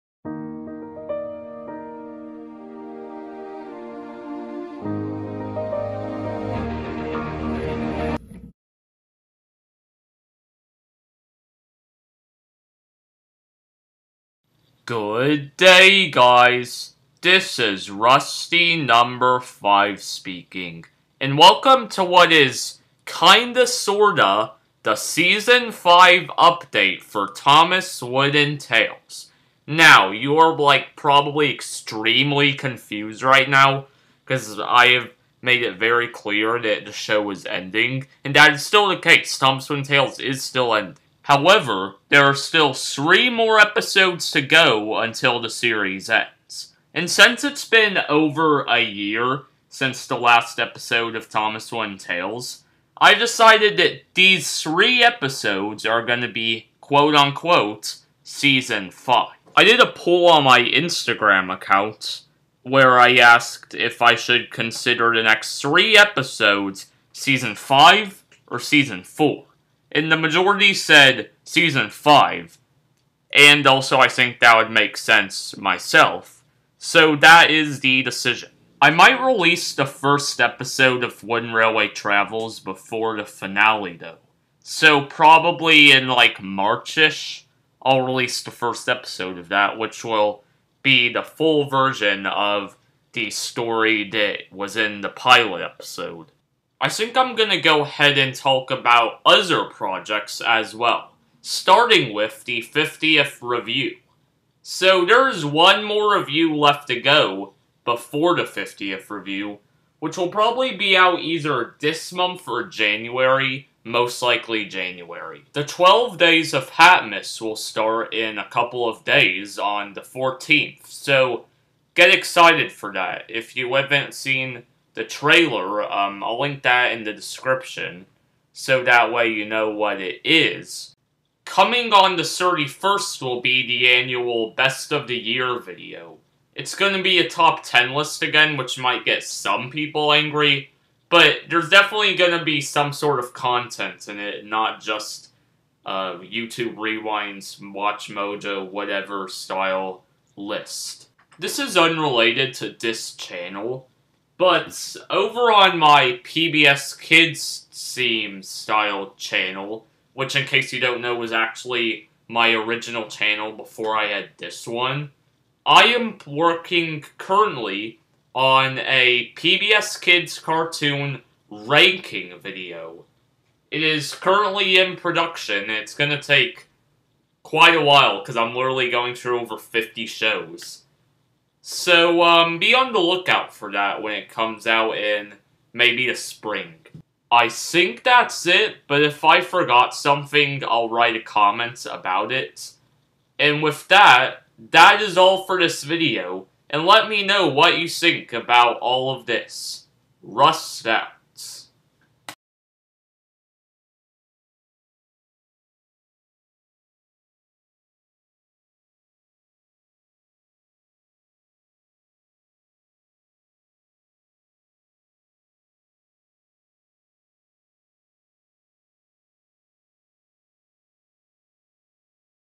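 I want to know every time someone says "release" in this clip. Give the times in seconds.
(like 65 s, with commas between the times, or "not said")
79 s, 88 s.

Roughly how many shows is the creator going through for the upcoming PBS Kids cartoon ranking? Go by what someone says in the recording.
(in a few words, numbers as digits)
over 50.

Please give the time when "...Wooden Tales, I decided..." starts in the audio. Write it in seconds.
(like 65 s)
51 s.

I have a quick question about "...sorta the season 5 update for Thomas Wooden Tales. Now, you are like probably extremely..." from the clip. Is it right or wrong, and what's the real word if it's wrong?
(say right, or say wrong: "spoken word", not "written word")
right.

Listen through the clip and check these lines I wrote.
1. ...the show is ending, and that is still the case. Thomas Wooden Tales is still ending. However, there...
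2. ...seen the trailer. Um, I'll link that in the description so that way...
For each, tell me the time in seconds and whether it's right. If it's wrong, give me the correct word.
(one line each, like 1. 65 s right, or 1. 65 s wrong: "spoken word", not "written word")
1. 36 s right
2. 124 s right.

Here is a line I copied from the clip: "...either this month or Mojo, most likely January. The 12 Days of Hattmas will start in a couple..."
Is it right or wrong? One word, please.
wrong.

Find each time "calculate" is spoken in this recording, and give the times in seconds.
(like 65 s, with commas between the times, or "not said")
not said.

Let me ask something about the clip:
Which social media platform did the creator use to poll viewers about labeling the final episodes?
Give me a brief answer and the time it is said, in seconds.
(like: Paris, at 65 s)
Instagram, at 60 s.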